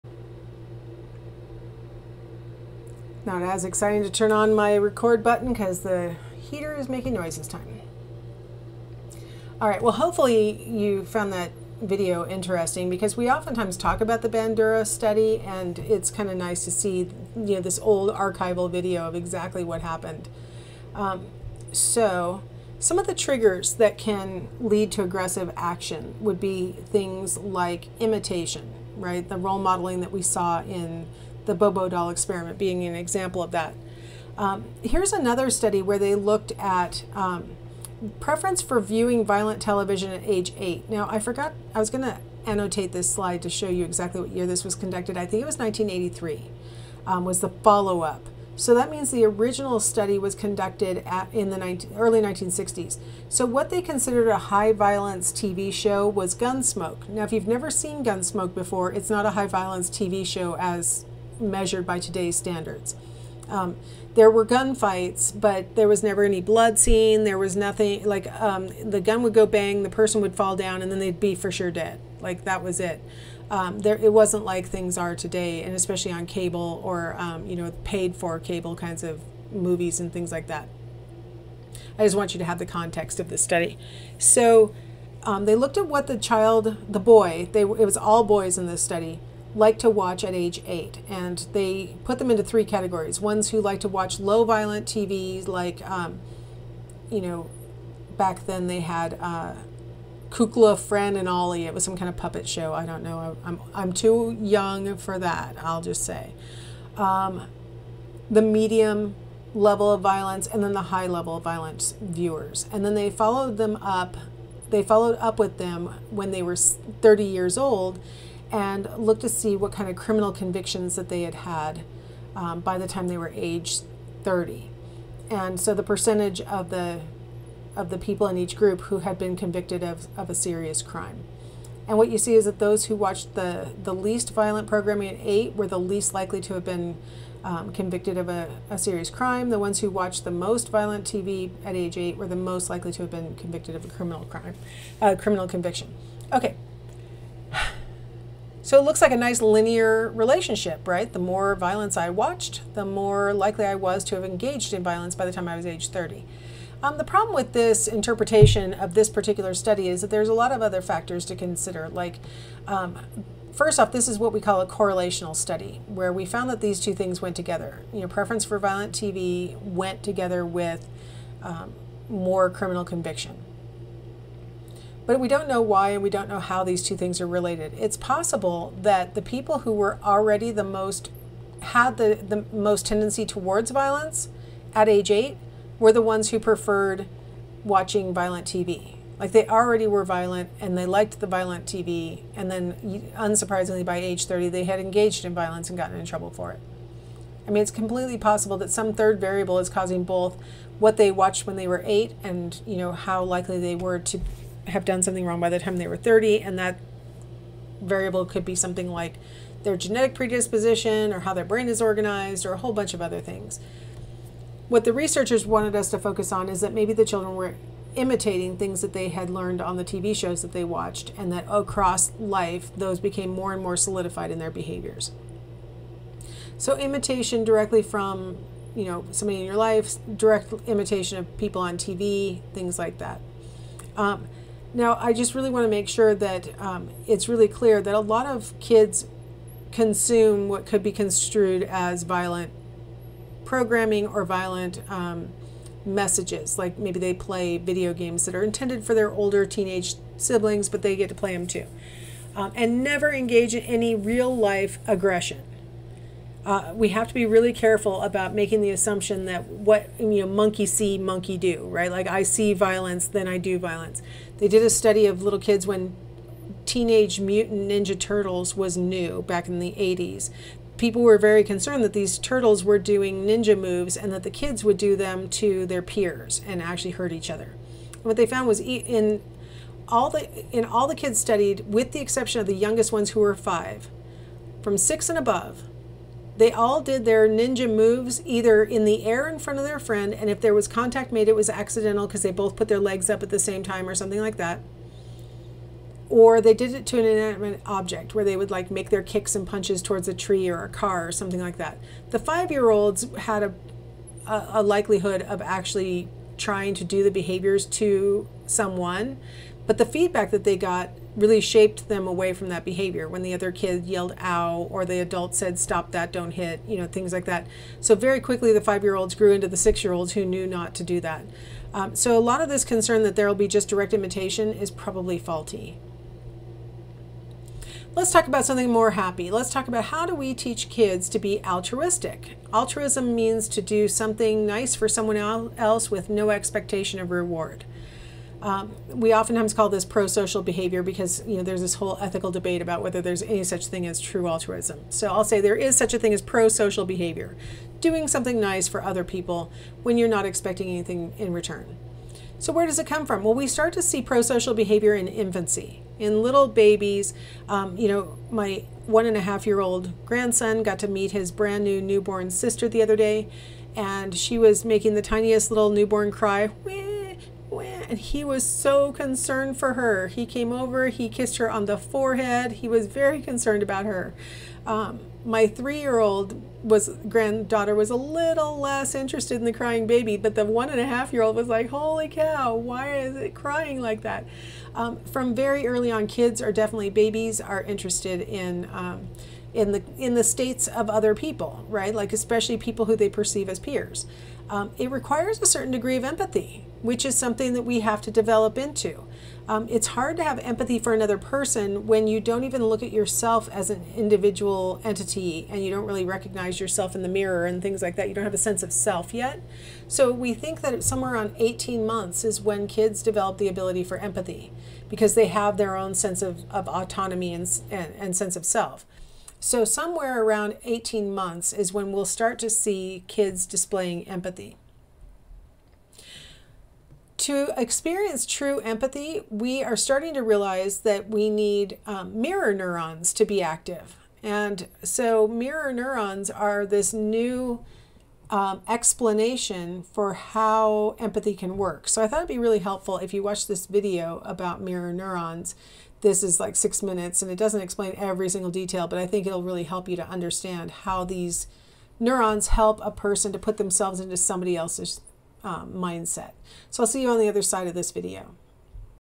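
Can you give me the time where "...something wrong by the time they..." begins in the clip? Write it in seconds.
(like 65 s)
205 s.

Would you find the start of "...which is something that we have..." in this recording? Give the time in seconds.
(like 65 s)
396 s.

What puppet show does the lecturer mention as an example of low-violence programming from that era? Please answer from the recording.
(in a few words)
Kukla, Fran, and Ollie.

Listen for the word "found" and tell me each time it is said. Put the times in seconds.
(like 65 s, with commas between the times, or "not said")
11 s, 166 s, 278 s.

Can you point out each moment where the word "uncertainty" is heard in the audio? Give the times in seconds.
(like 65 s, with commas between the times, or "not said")
not said.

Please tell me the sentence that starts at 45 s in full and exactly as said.
I think it was 1983 um, was the follow-up.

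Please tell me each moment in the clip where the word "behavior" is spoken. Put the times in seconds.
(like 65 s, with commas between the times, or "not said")
224 s, 307 s, 312 s, 340 s, 346 s, 354 s.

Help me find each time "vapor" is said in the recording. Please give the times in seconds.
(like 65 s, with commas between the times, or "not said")
not said.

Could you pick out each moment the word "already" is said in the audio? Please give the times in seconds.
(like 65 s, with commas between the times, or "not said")
180 s, 189 s.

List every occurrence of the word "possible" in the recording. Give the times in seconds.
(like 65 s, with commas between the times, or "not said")
177 s, 198 s.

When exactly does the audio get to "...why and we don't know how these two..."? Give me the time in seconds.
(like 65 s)
175 s.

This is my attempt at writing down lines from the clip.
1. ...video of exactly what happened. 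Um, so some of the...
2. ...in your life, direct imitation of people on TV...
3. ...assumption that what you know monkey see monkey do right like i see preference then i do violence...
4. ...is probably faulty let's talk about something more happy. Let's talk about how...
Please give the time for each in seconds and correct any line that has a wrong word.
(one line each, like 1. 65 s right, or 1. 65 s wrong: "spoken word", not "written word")
1. 18 s right
2. 229 s right
3. 258 s wrong: "violence", not "preference"
4. 324 s right.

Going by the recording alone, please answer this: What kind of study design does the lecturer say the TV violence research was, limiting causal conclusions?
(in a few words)
Correlational study.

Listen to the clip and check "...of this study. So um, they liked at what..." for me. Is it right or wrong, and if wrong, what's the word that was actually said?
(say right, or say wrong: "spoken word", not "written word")
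wrong: "looked", not "liked".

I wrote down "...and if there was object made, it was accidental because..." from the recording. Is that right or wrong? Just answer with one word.
wrong.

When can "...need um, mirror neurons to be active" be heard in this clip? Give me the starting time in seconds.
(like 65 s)
431 s.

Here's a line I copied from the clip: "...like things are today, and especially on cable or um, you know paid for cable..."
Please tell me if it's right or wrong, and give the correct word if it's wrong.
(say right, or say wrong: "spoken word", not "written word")
right.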